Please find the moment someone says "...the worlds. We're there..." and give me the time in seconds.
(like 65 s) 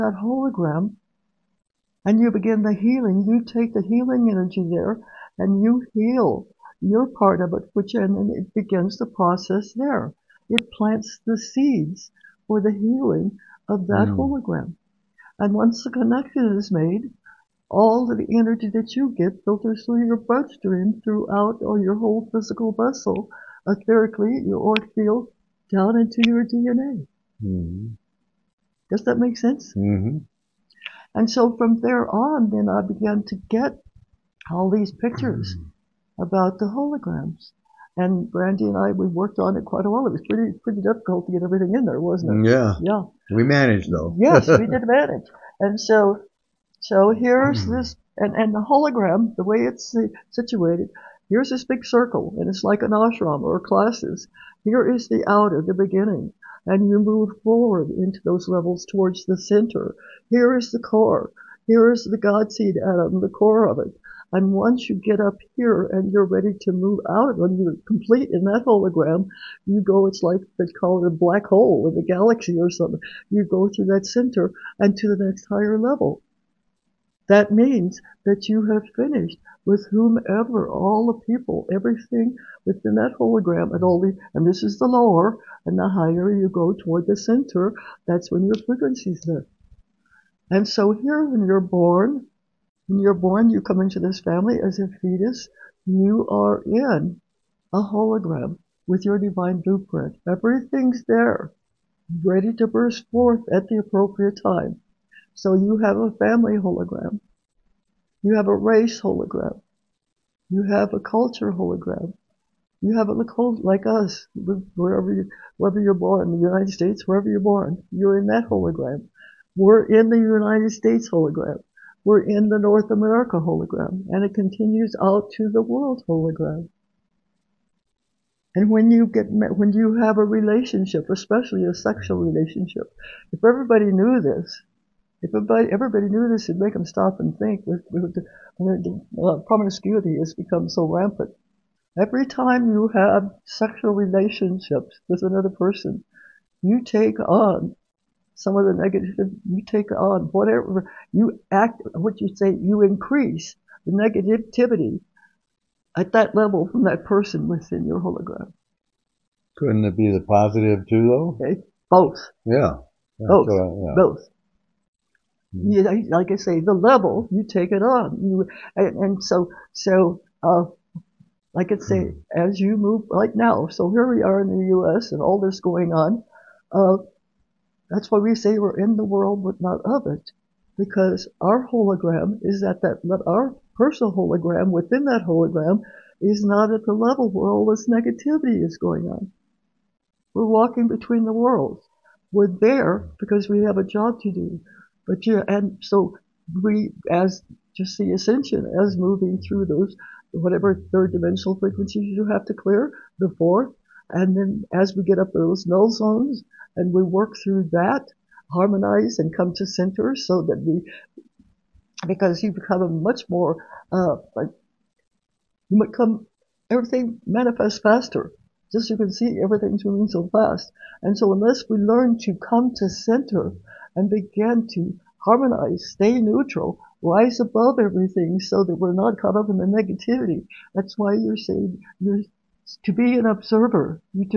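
191 s.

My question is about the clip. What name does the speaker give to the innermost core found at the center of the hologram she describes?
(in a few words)
God seed atom.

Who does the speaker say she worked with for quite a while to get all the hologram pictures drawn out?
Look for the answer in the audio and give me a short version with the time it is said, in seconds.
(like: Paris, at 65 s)
Brandy, at 38 s.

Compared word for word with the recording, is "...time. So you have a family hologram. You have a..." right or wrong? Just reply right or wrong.
right.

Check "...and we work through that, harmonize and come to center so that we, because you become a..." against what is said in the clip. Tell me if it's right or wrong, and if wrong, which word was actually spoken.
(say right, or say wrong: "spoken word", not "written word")
right.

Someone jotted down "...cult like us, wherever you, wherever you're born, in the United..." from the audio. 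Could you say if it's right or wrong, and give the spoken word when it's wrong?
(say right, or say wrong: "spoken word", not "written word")
right.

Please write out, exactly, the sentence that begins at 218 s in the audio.
Just you can see, everything's moving so fast.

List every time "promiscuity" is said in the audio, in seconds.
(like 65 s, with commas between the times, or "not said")
139 s.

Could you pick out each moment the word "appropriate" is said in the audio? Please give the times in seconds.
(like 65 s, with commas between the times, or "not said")
103 s.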